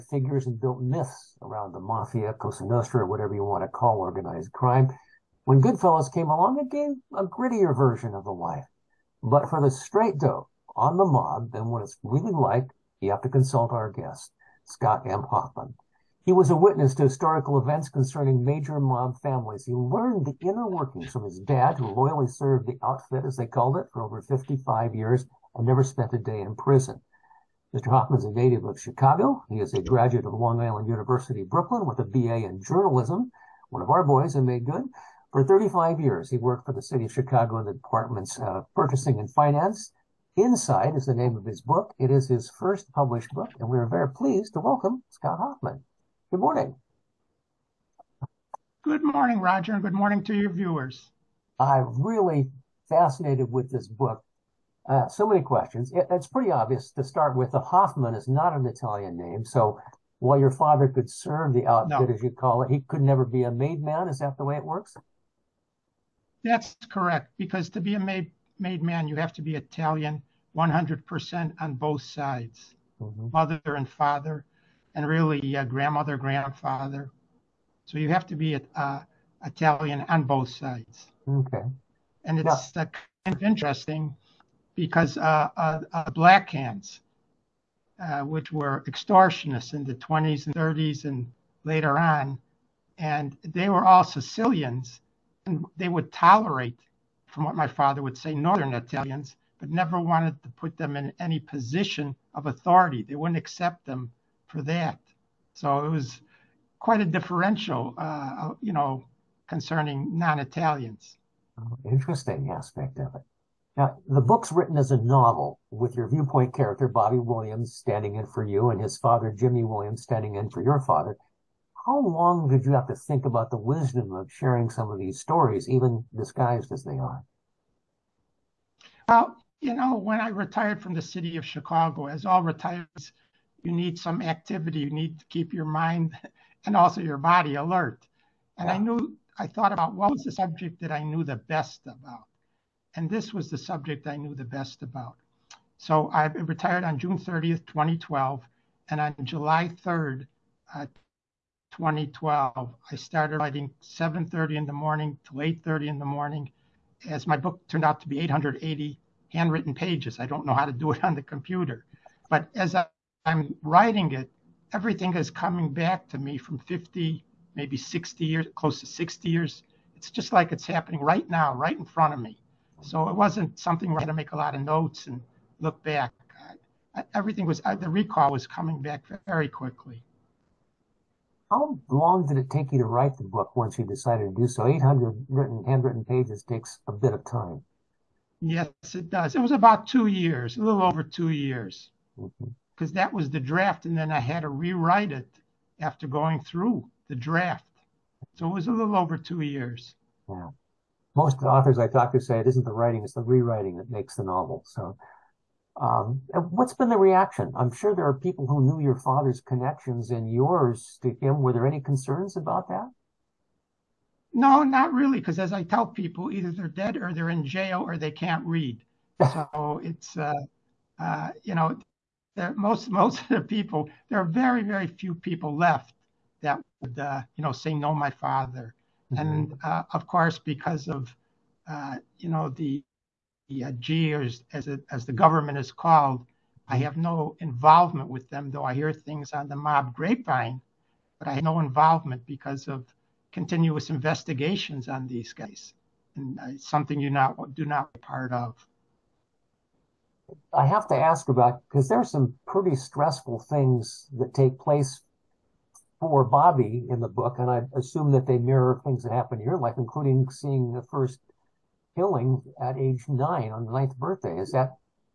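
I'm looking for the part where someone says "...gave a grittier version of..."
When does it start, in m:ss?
0:06.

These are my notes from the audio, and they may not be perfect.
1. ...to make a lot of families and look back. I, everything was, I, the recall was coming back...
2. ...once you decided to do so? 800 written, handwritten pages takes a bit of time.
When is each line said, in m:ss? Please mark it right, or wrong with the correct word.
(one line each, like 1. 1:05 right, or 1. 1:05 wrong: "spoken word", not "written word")
1. 2:54 wrong: "notes", not "families"
2. 3:03 right.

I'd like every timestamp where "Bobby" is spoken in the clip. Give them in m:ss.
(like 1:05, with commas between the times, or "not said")
1:56, 4:16.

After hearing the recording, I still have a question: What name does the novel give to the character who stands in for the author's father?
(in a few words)
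Jimmy Williams.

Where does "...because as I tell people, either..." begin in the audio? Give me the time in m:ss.
3:35.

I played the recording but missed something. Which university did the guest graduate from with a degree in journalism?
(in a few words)
Long Island University.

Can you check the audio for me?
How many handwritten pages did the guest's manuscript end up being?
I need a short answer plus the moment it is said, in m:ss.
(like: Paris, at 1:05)
880, at 2:38.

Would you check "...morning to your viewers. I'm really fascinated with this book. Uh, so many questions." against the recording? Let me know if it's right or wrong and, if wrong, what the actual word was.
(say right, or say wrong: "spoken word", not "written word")
right.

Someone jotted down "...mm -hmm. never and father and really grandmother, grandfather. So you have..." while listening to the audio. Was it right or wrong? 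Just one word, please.
wrong.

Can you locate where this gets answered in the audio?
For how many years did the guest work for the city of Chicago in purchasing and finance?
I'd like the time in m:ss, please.
0:35.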